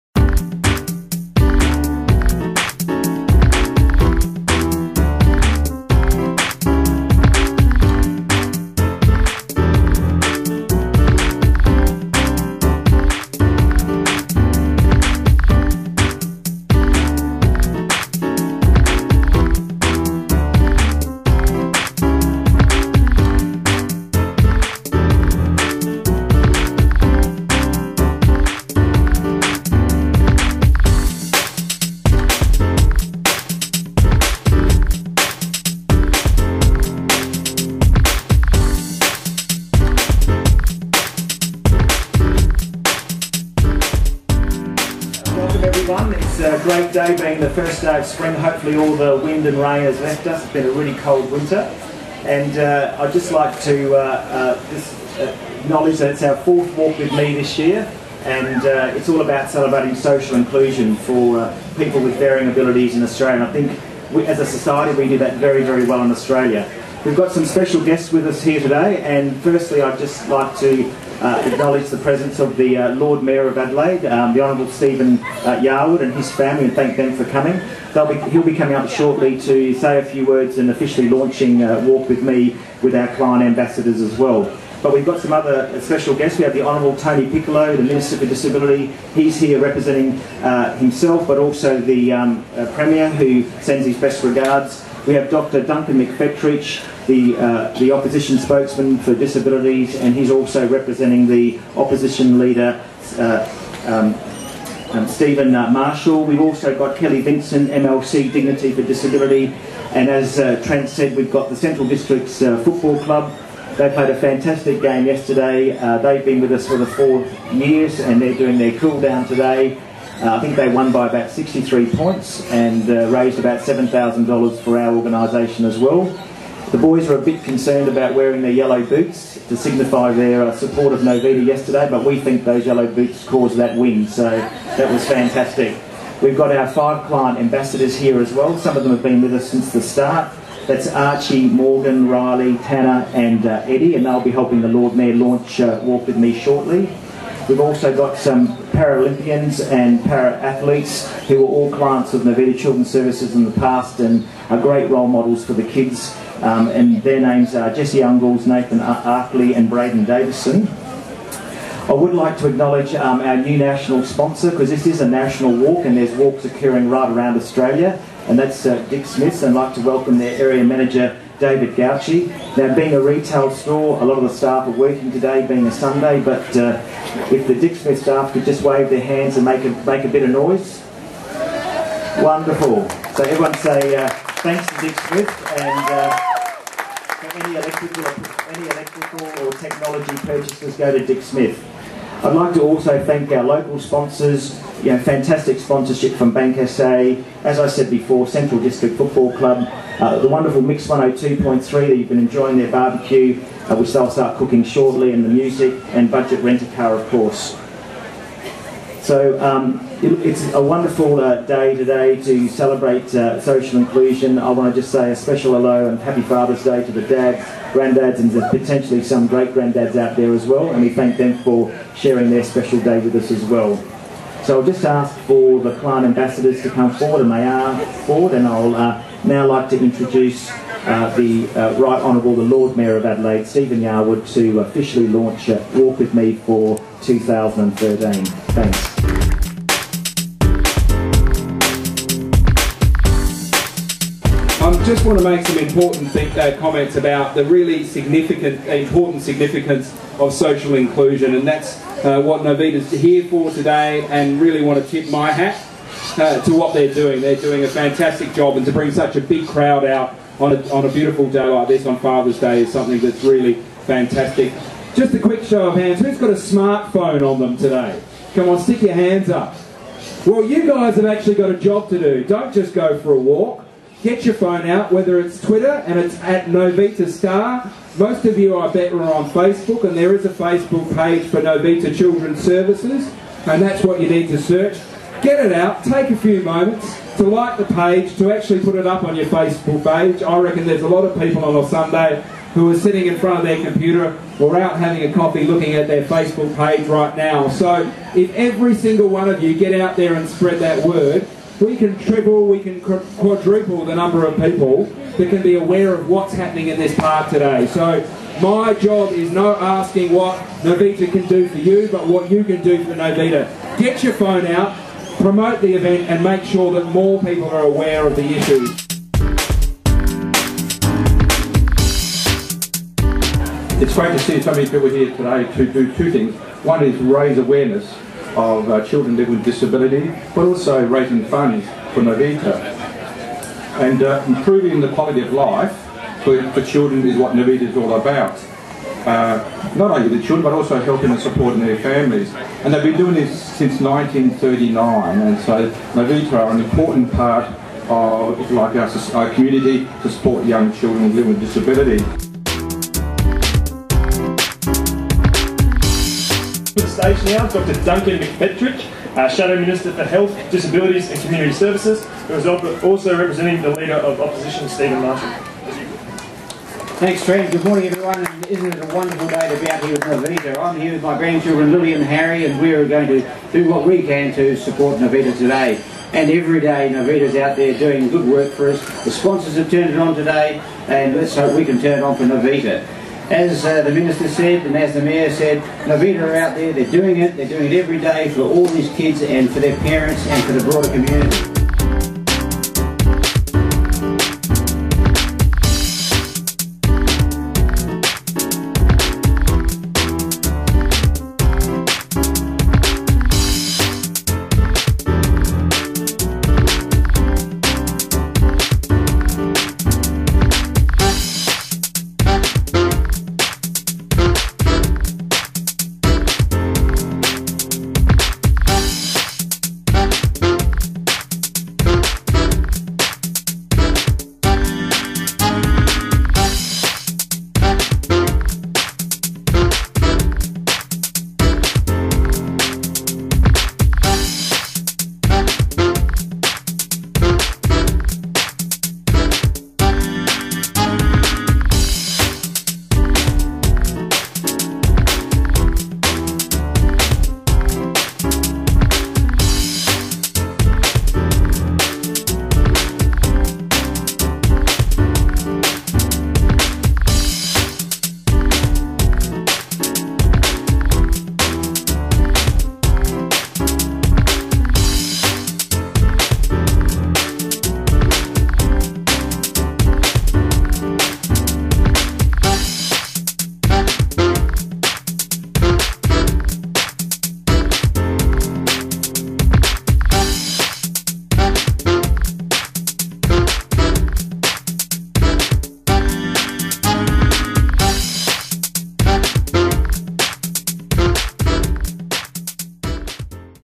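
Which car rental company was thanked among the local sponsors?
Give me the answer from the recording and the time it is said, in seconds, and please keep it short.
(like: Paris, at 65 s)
Budget Rent-A-Car, at 206 s.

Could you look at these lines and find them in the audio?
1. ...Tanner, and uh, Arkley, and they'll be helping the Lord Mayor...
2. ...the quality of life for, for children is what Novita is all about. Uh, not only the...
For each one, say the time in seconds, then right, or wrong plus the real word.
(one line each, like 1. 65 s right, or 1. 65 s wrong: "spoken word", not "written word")
1. 142 s wrong: "Eddie", not "Arkley"
2. 334 s right.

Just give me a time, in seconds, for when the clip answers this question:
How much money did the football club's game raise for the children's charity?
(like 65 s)
123 s.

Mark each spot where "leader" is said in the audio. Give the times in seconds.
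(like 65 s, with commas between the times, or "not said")
102 s, 363 s.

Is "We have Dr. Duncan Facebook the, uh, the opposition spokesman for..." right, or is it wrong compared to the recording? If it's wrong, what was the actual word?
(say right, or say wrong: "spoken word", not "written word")
wrong: "McFetridge", not "Facebook".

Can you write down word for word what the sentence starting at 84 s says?
But we've got some other uh, special guests.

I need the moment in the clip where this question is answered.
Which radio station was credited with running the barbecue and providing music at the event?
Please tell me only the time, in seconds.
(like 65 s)
200 s.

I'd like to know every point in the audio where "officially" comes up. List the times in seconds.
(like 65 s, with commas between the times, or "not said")
80 s, 234 s.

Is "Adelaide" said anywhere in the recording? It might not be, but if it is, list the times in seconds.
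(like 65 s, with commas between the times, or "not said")
73 s, 233 s.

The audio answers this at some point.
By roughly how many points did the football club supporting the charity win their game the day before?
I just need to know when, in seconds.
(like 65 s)
121 s.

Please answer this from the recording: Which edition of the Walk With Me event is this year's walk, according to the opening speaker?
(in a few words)
fourth.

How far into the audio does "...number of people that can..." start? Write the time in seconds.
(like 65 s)
303 s.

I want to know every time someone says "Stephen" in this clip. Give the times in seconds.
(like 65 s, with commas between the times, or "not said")
74 s, 105 s, 233 s, 364 s.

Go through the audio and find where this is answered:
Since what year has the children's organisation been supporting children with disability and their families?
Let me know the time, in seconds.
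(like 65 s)
343 s.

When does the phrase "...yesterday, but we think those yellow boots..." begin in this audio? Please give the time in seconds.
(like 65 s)
131 s.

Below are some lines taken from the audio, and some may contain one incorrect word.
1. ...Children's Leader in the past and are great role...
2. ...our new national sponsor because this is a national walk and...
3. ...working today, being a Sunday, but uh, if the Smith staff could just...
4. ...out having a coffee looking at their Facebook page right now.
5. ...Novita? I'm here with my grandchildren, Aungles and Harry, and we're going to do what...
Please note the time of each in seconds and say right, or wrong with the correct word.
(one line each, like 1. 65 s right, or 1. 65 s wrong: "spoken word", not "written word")
1. 152 s wrong: "Services", not "Leader"
2. 163 s right
3. 174 s right
4. 294 s right
5. 370 s wrong: "Lily", not "Aungles".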